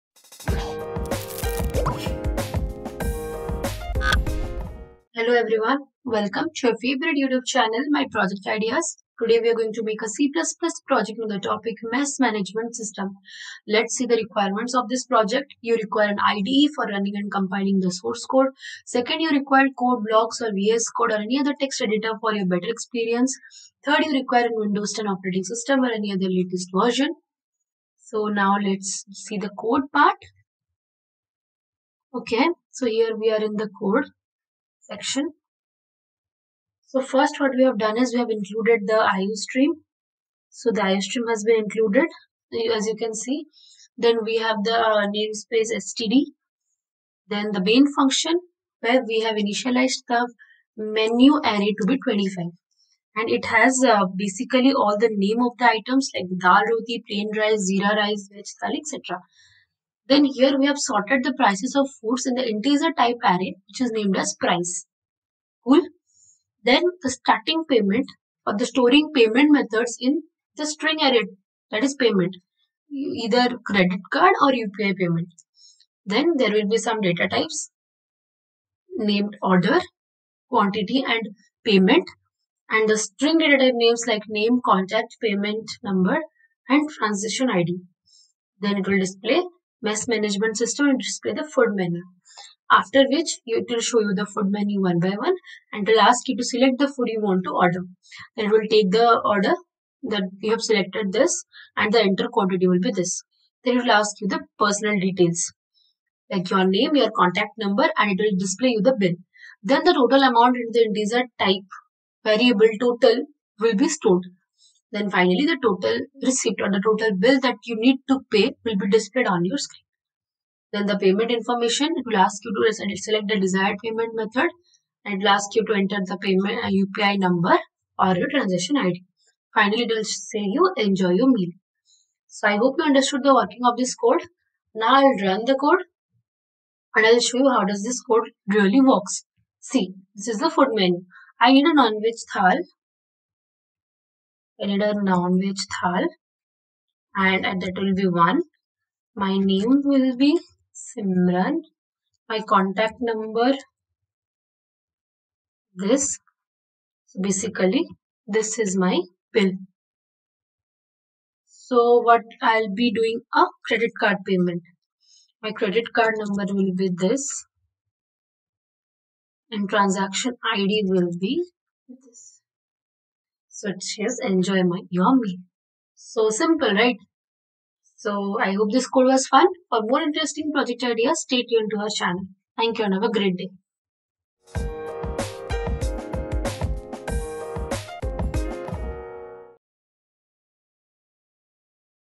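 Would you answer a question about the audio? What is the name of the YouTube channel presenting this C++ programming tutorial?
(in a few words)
My Project Ideas.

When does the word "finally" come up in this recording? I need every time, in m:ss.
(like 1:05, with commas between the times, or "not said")
1:55, 2:09.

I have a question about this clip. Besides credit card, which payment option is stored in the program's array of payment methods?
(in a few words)
UPI payment.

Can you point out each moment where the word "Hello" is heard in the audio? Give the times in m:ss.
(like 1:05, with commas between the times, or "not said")
0:05.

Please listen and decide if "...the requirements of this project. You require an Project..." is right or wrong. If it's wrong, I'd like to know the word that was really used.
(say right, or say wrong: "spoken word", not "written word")
wrong: "IDE", not "Project".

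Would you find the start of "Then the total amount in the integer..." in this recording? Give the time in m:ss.
1:49.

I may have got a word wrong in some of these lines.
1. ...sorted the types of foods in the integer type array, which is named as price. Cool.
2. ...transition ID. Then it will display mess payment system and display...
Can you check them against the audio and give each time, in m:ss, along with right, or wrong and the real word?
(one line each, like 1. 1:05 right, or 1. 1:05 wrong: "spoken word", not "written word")
1. 1:00 wrong: "prices", not "types"
2. 1:26 wrong: "management", not "payment".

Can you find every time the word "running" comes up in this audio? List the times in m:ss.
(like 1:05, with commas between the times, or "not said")
0:16.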